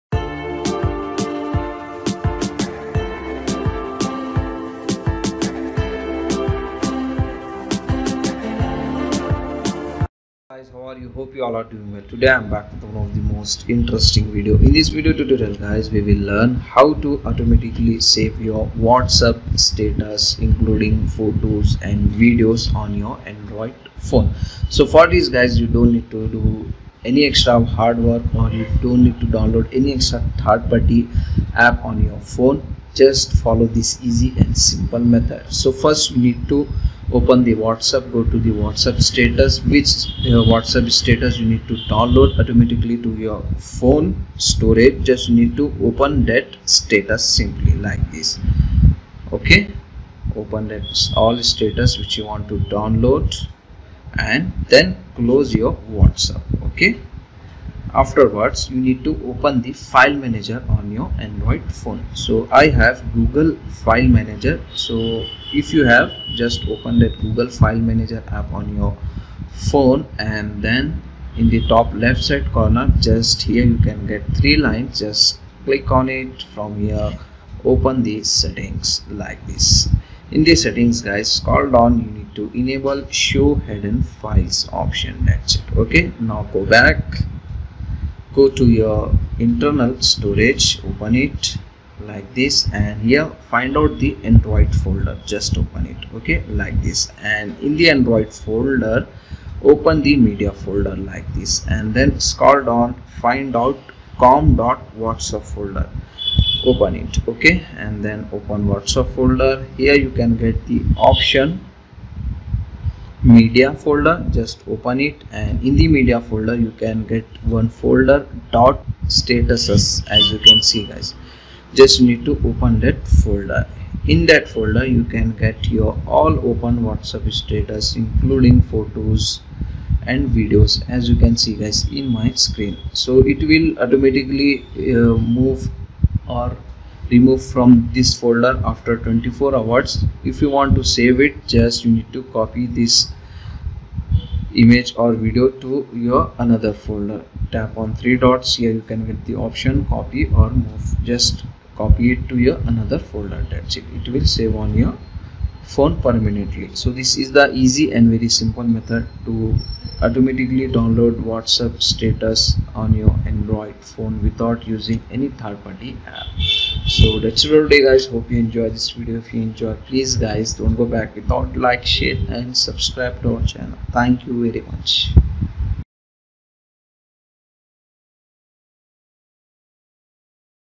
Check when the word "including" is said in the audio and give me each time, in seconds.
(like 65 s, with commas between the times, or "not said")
20 s, 127 s.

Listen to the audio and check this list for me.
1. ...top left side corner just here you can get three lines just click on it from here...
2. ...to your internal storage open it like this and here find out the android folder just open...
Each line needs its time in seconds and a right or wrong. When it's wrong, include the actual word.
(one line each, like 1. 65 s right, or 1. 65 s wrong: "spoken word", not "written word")
1. 71 s right
2. 88 s right.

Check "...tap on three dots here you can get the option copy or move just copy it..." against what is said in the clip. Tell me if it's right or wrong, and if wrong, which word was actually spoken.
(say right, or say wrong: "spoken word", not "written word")
right.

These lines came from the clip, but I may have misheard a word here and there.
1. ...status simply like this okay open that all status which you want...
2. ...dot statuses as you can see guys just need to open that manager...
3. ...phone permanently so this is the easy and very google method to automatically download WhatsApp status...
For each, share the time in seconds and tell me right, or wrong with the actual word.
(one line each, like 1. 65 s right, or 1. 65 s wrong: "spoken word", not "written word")
1. 46 s right
2. 118 s wrong: "folder", not "manager"
3. 155 s wrong: "simple", not "google".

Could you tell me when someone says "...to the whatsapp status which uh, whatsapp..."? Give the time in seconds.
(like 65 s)
38 s.